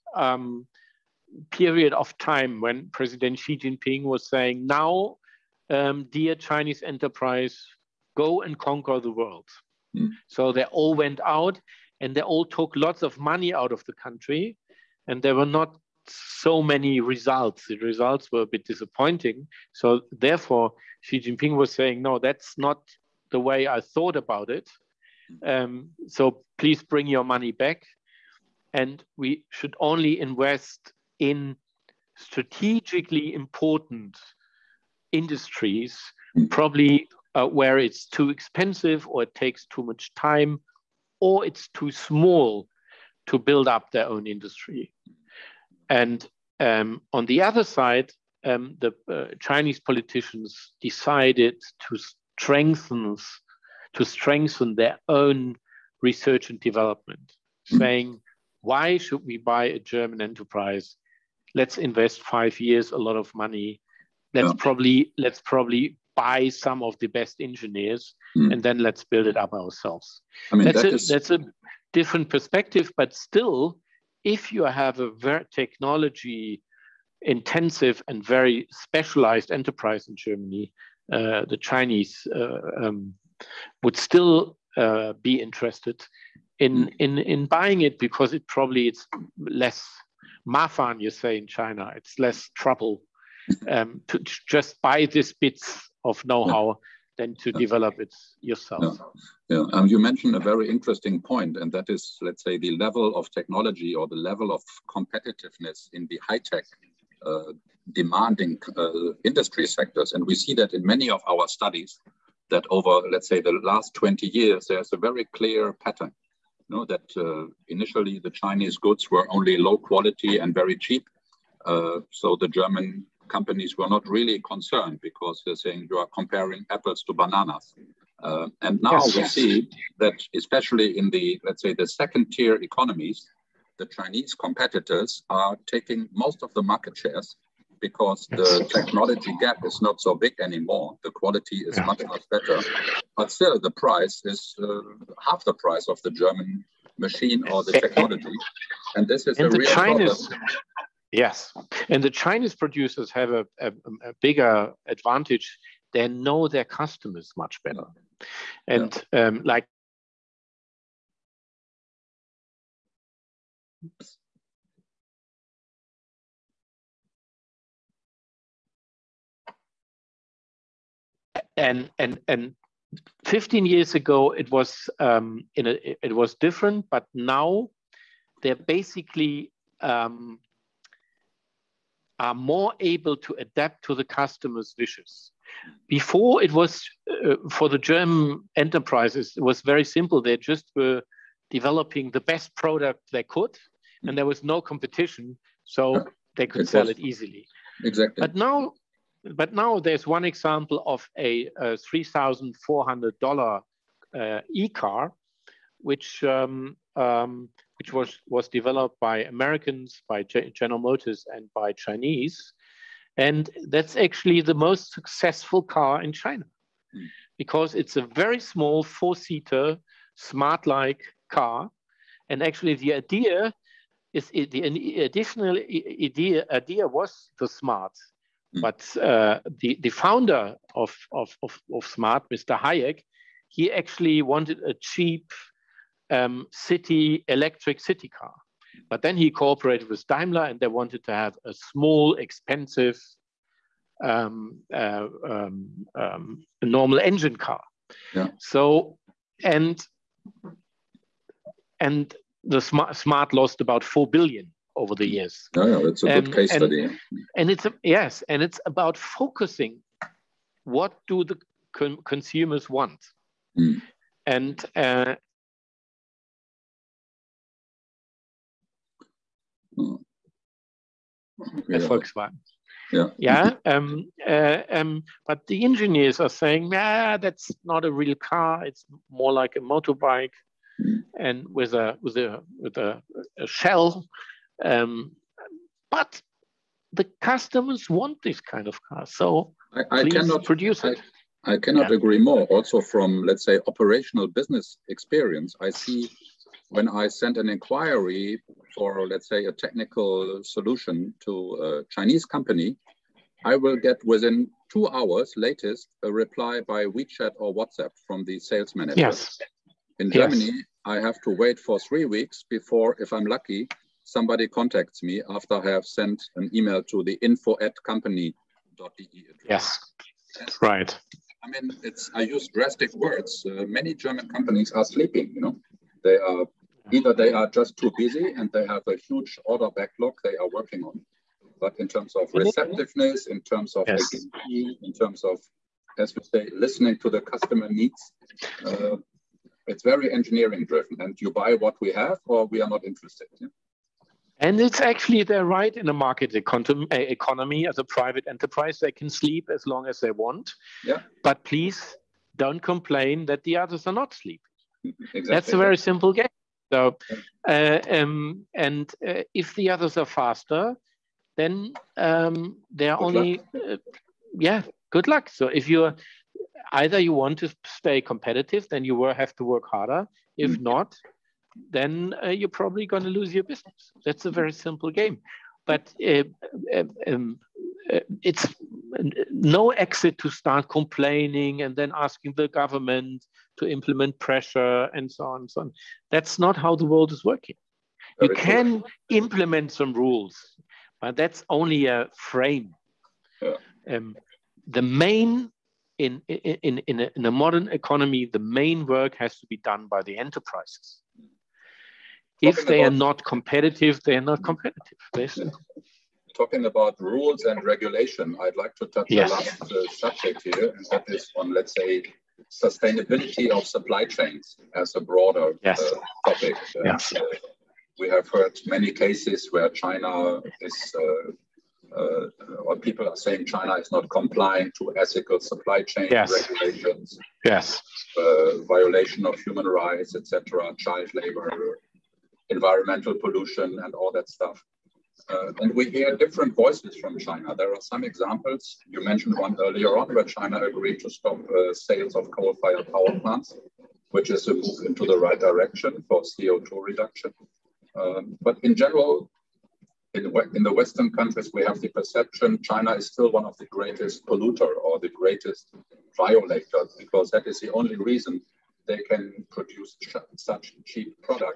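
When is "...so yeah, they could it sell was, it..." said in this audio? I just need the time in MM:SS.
03:15.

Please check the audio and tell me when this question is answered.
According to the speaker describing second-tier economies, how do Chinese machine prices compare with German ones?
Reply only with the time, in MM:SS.
02:25.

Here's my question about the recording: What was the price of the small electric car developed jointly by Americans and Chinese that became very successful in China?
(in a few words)
$3,400.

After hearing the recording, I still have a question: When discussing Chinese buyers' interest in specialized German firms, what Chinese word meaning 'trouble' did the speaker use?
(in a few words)
mafan.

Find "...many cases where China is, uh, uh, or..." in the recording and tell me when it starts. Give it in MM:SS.
06:58.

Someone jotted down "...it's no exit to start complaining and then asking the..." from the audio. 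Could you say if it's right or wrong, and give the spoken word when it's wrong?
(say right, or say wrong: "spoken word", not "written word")
right.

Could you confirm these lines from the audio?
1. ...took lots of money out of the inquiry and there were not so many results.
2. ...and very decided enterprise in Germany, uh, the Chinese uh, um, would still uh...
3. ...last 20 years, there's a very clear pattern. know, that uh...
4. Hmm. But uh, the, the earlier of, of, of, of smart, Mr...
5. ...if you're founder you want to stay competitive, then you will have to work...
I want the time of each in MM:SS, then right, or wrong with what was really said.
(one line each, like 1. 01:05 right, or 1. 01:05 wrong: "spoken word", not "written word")
1. 00:12 wrong: "country", not "inquiry"
2. 01:18 wrong: "specialized", not "decided"
3. 01:53 right
4. 03:48 wrong: "founder", not "earlier"
5. 06:05 wrong: "either", not "founder".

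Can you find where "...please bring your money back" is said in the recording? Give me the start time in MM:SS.
00:26.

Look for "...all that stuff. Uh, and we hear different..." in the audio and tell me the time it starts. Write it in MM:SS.
07:13.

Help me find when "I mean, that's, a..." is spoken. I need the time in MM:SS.
01:10.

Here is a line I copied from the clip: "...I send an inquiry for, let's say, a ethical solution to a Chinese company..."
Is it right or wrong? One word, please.
wrong.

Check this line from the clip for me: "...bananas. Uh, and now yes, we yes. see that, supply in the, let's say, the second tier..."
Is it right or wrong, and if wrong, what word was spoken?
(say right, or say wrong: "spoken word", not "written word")
wrong: "especially", not "supply".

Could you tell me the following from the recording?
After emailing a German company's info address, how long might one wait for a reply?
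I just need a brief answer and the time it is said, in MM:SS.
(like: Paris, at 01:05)
3 weeks, at 05:11.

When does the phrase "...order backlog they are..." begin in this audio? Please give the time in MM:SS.
05:29.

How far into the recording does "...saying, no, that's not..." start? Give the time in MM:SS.
00:21.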